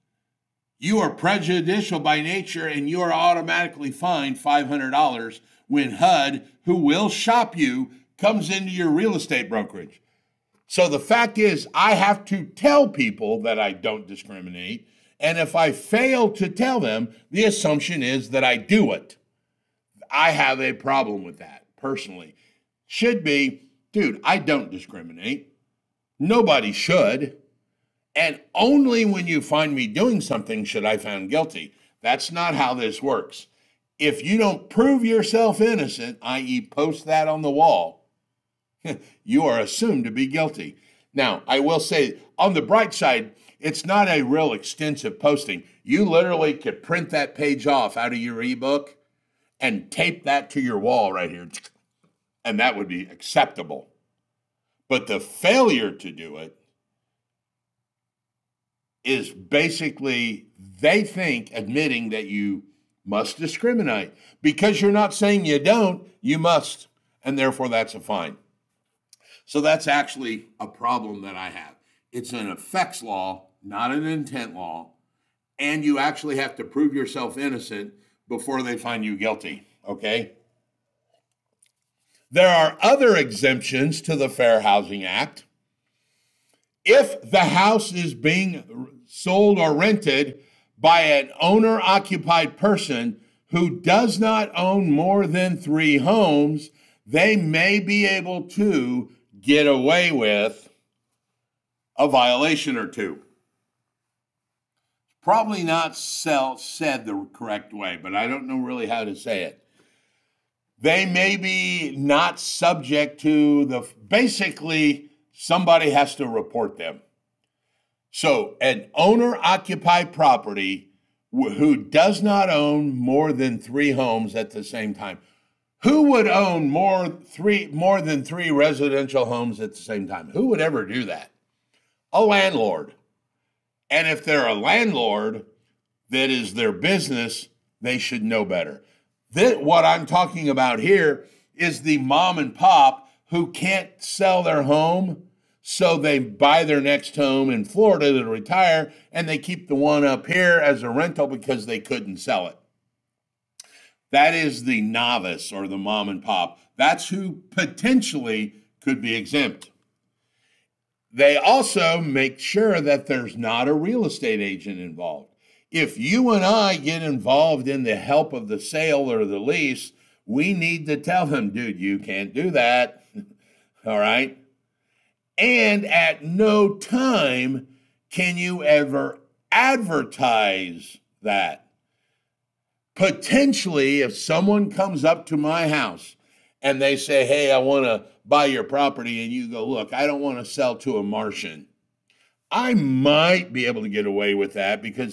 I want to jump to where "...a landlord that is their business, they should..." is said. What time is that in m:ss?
2:14.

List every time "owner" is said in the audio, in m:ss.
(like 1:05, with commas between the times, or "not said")
1:31, 1:58.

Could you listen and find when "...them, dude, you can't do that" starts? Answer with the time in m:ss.
2:51.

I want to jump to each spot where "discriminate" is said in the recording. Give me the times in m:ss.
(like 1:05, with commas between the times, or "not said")
0:14, 0:24, 1:03.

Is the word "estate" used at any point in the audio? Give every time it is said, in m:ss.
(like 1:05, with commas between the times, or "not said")
0:09, 2:44.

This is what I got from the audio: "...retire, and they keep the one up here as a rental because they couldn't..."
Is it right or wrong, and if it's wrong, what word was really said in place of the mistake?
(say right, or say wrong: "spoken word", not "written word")
right.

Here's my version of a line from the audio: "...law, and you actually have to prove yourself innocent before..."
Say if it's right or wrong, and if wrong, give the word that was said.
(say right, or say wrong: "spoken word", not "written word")
right.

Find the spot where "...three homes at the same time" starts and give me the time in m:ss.
2:03.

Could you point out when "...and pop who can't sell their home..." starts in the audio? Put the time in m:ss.
2:22.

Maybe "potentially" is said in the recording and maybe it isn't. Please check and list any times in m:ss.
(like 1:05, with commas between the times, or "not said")
2:37, 3:02.